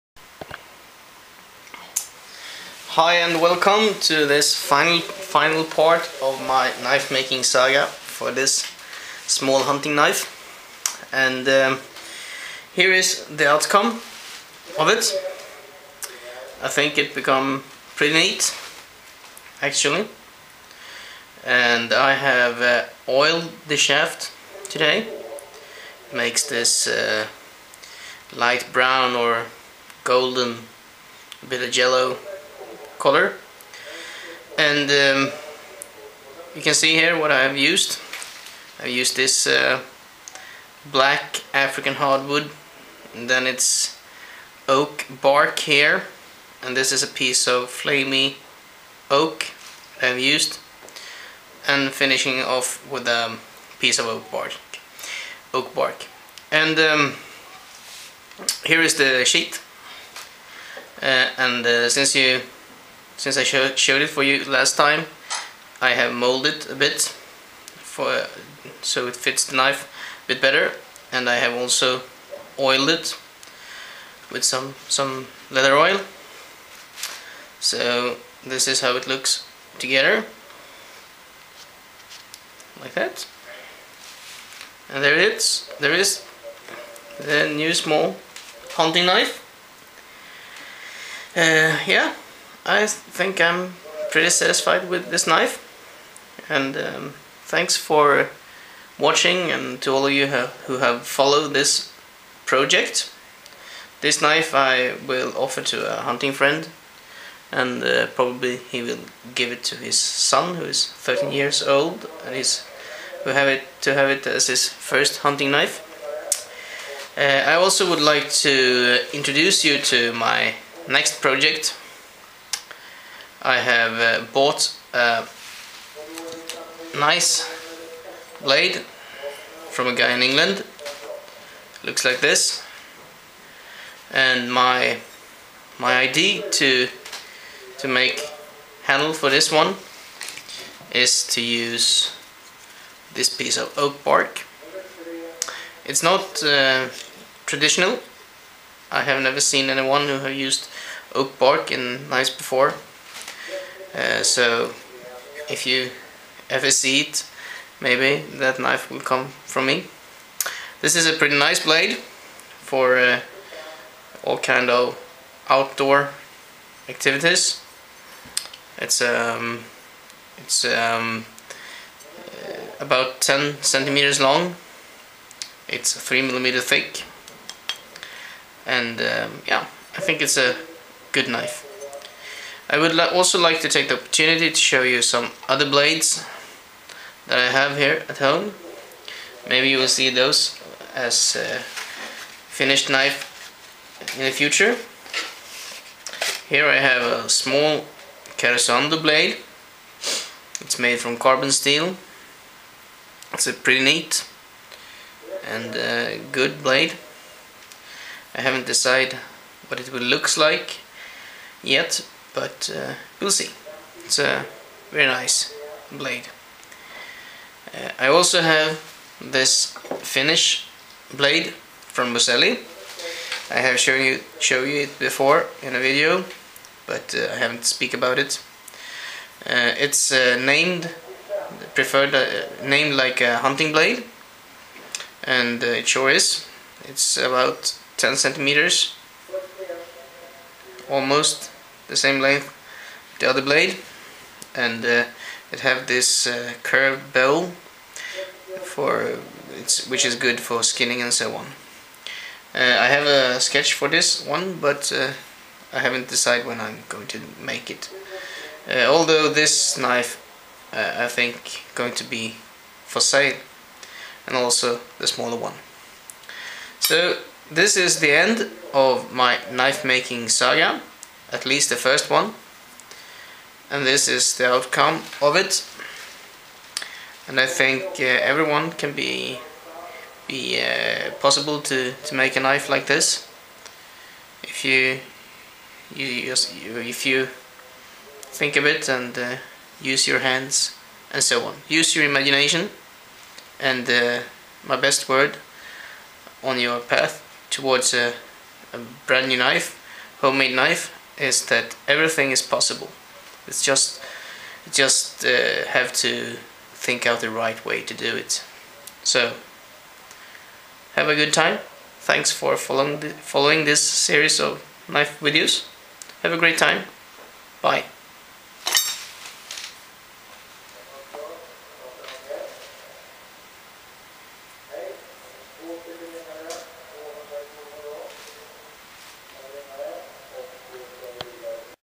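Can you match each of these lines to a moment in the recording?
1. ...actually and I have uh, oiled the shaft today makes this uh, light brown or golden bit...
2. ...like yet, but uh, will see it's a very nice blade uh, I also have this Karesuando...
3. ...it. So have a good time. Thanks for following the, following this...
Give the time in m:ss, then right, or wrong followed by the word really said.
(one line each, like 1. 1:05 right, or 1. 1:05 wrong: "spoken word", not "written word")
1. 0:19 right
2. 3:30 wrong: "Finnish", not "Karesuando"
3. 5:08 right.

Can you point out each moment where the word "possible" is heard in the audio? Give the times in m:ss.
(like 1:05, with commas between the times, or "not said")
4:41, 5:02.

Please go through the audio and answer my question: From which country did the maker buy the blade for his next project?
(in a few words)
England.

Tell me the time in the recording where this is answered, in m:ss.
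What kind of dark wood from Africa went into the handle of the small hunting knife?
0:40.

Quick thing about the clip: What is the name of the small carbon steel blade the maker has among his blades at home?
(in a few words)
Karesuando.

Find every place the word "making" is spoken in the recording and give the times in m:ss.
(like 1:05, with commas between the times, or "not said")
0:07, 4:29.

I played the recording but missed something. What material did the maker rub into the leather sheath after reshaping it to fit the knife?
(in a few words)
leather oil.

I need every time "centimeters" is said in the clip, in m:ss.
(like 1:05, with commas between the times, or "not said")
2:53, 3:58.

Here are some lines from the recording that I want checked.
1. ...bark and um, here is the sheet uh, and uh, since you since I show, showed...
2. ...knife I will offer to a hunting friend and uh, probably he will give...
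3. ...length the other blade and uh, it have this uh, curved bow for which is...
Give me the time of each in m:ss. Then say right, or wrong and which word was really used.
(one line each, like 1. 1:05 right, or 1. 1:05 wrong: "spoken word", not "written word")
1. 0:55 right
2. 1:44 right
3. 4:02 right.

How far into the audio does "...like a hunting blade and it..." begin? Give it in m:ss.
3:52.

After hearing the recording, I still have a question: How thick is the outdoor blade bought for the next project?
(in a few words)
3 millimeters.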